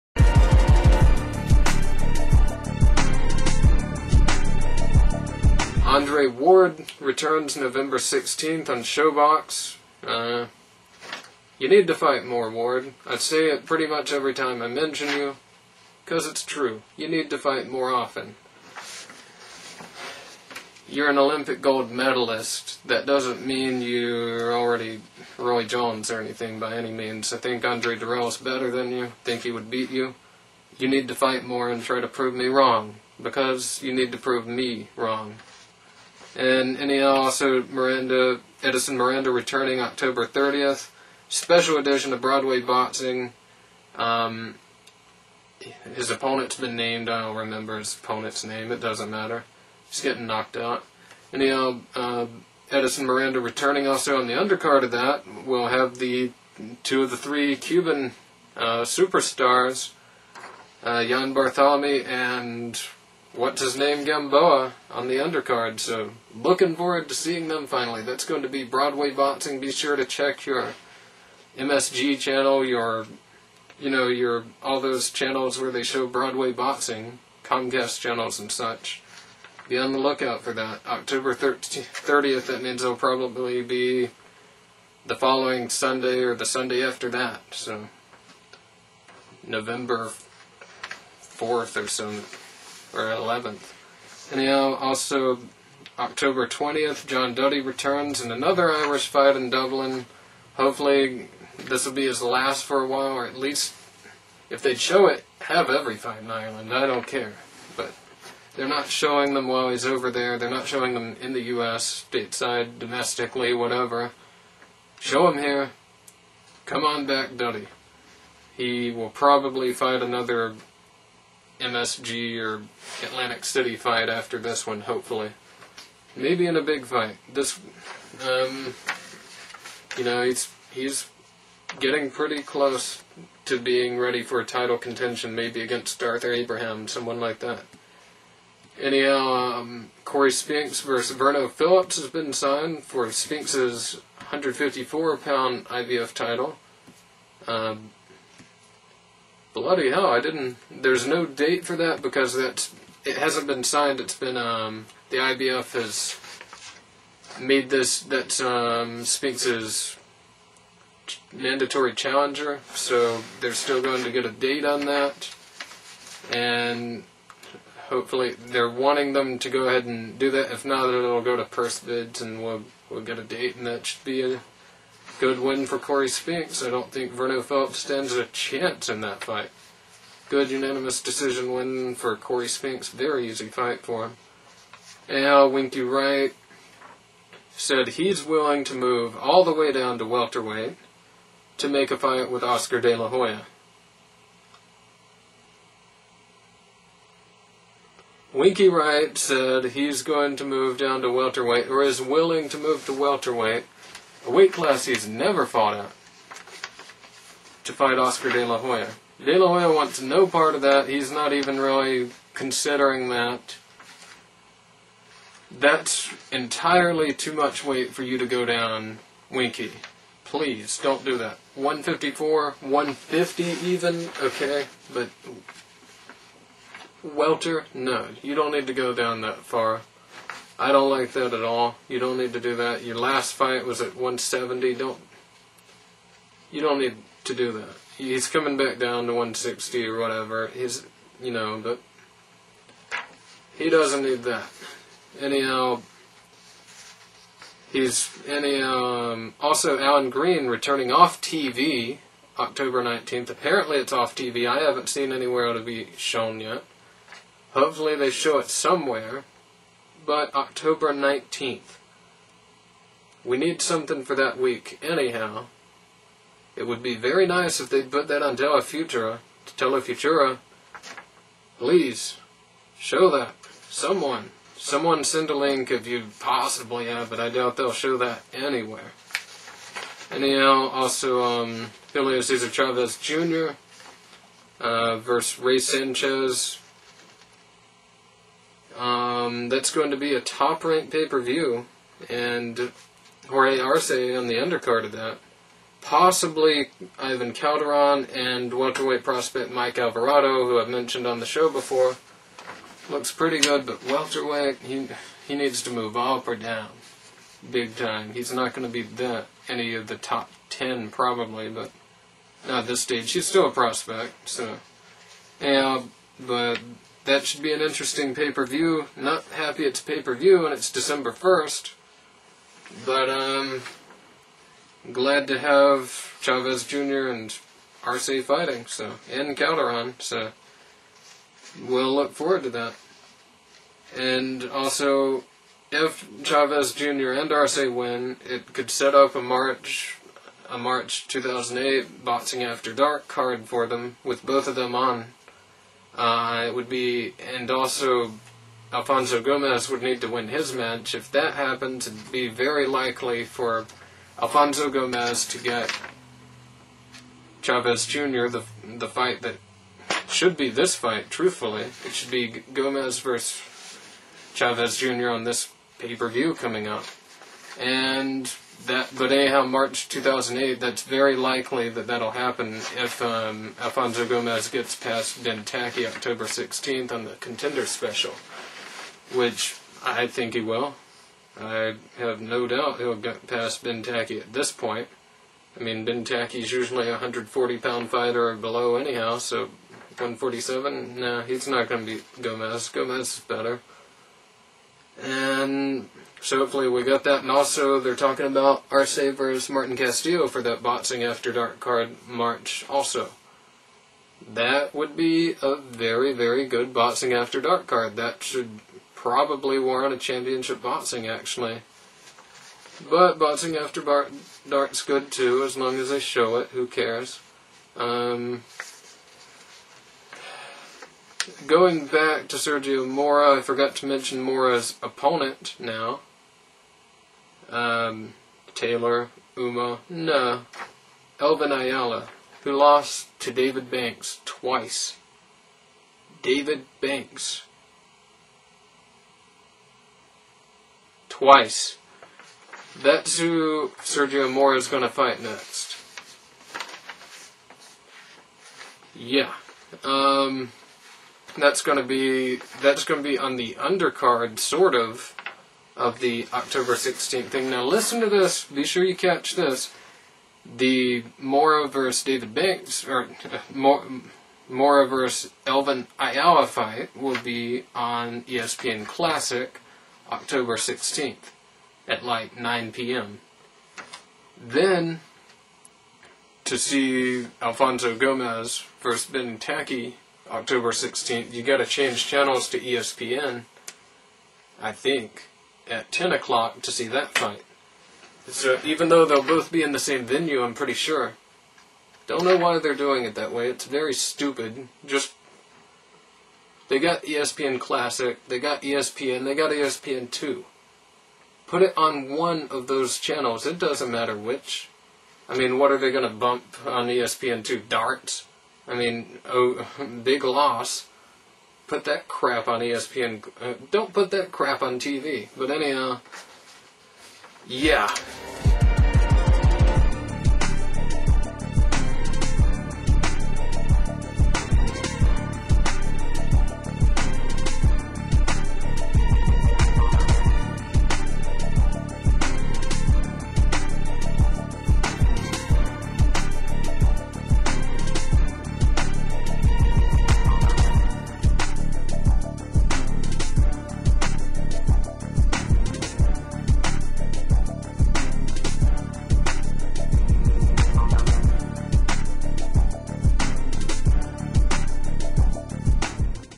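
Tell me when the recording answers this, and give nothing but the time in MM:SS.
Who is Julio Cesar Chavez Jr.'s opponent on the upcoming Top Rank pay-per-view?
04:45.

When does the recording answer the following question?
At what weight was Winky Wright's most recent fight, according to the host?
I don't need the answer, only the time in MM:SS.
03:53.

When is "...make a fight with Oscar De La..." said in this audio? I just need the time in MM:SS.
03:11.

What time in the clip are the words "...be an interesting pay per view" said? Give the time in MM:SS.
05:17.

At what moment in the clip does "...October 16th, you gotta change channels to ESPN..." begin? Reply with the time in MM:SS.
08:00.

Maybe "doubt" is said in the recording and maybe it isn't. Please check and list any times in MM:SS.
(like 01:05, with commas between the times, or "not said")
04:37, 06:22.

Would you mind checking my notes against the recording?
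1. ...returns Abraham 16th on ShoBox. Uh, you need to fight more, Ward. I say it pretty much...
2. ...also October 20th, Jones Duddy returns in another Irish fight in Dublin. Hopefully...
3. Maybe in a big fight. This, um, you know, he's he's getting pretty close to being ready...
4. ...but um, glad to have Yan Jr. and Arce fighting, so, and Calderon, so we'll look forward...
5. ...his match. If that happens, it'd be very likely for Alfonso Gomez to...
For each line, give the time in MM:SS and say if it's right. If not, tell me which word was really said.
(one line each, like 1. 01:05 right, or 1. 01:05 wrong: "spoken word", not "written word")
1. 00:06 wrong: "November", not "Abraham"
2. 01:34 wrong: "John", not "Jones"
3. 02:06 right
4. 05:22 wrong: "Chavez", not "Yan"
5. 05:50 right.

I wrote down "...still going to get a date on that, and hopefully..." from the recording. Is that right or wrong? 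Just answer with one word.
right.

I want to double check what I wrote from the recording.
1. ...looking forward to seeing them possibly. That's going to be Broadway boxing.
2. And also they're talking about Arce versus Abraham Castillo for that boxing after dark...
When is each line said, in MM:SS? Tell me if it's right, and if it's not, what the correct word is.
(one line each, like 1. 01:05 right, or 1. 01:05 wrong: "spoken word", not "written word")
1. 01:06 wrong: "finally", not "possibly"
2. 06:37 wrong: "Martin", not "Abraham".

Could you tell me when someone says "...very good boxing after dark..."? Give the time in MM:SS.
06:46.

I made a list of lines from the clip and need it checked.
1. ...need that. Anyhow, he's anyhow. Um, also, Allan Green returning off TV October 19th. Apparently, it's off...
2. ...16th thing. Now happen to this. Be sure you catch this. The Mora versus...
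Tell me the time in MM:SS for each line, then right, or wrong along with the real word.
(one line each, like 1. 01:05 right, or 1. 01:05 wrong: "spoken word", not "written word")
1. 04:04 right
2. 07:36 wrong: "listen", not "happen".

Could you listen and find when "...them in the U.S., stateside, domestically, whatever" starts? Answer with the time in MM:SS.
01:50.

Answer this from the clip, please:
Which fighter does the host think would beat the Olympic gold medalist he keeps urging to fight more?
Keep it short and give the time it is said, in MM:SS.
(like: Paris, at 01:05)
Andre Dirrell, at 00:27.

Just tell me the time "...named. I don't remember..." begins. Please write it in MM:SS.
00:46.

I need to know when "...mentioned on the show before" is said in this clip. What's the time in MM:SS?
05:00.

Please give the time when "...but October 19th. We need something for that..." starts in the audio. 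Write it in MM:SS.
04:20.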